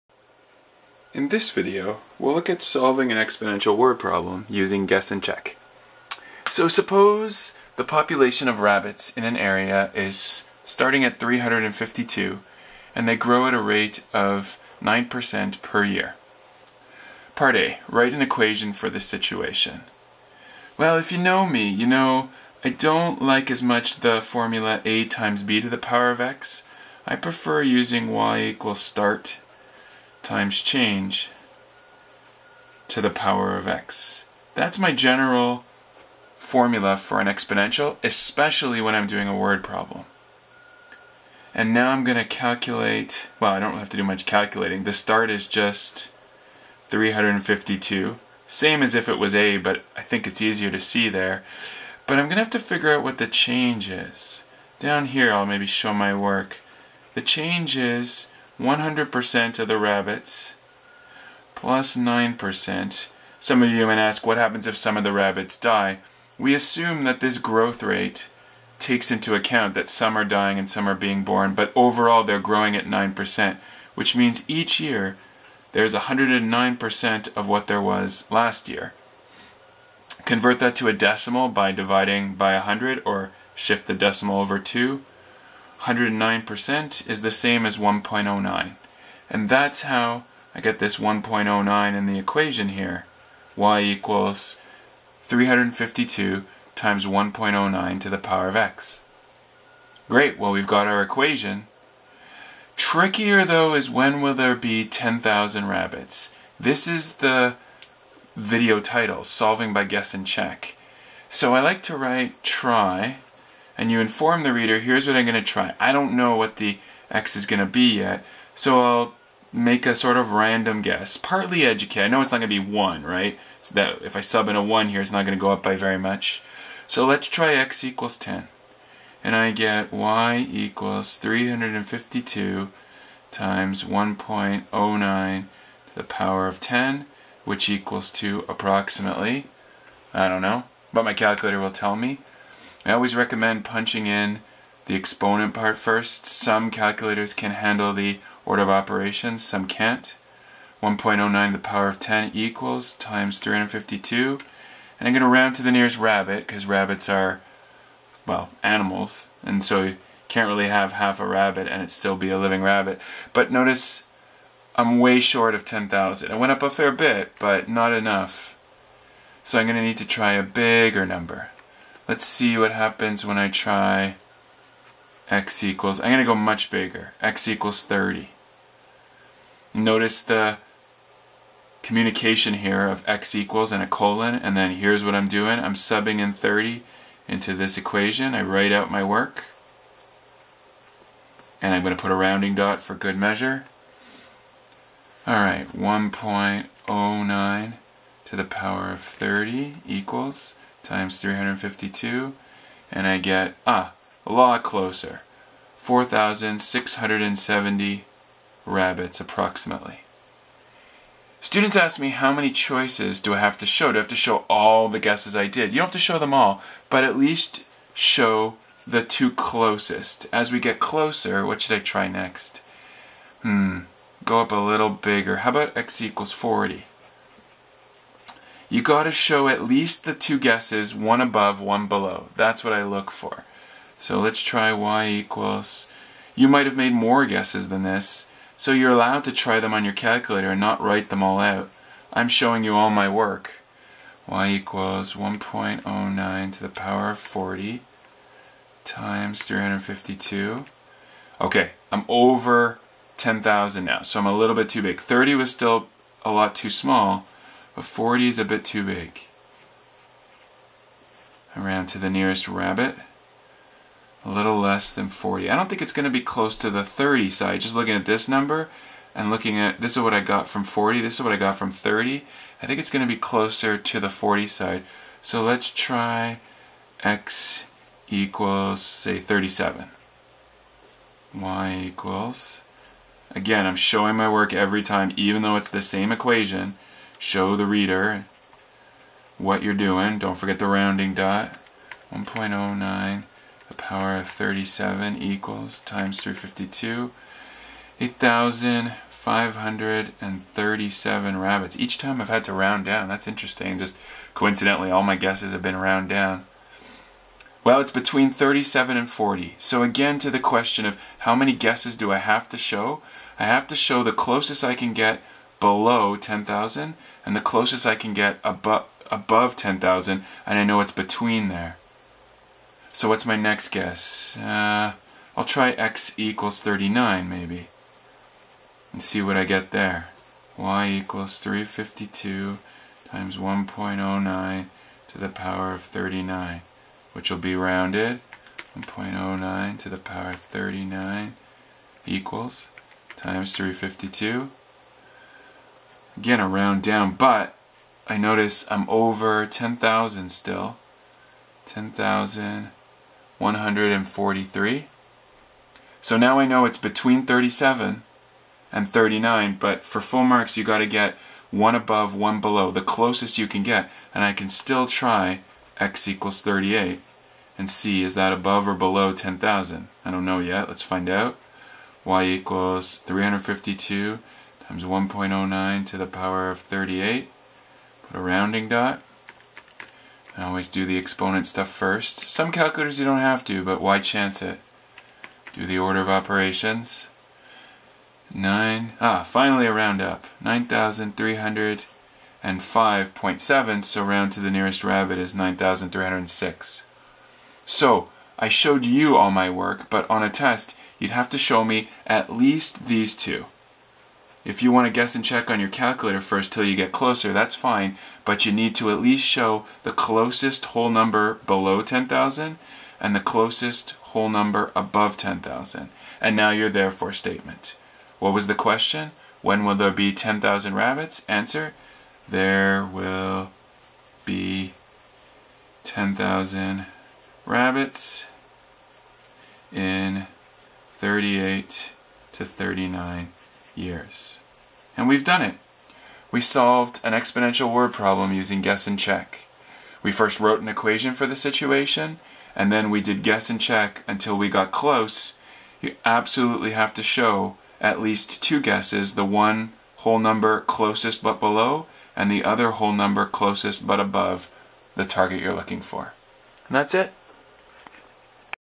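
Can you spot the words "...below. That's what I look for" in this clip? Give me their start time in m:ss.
3:51.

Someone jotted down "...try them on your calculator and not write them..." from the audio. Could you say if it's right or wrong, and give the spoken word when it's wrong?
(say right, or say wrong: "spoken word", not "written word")
right.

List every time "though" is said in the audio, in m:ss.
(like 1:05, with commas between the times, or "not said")
1:43, 4:45.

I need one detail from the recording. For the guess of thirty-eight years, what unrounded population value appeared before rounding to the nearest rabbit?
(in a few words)
9,305.7.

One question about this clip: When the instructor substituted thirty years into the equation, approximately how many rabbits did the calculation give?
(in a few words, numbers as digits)
4,670.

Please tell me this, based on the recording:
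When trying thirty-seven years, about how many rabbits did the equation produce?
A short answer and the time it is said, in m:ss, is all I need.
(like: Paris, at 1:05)
8,537, at 4:58.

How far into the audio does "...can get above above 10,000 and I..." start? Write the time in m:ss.
5:17.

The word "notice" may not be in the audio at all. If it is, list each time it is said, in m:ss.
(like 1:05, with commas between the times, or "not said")
2:43, 2:59, 5:48.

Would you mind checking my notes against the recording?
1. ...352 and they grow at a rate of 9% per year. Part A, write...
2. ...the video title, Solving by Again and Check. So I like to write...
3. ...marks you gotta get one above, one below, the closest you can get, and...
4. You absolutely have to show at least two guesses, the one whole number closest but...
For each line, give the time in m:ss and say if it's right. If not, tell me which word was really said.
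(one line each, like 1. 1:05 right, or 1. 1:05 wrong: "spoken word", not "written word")
1. 0:11 right
2. 1:47 wrong: "Guess", not "Again"
3. 6:00 right
4. 7:25 right.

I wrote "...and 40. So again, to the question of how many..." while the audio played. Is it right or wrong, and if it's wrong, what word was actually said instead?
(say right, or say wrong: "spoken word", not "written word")
right.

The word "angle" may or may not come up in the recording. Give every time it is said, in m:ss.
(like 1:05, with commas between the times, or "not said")
not said.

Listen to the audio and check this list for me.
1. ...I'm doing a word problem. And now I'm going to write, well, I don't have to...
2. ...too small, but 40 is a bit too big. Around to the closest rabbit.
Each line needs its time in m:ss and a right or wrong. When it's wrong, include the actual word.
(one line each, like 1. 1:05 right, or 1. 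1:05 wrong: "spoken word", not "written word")
1. 0:38 wrong: "calculate", not "write"
2. 4:16 wrong: "nearest", not "closest".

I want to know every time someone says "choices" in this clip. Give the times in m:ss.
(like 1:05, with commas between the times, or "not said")
3:32.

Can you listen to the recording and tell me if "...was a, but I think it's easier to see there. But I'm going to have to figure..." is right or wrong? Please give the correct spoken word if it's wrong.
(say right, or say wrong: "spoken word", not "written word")
right.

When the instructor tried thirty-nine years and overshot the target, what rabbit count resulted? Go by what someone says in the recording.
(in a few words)
10,143.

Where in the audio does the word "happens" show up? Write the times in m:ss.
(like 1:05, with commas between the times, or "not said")
1:04, 2:52.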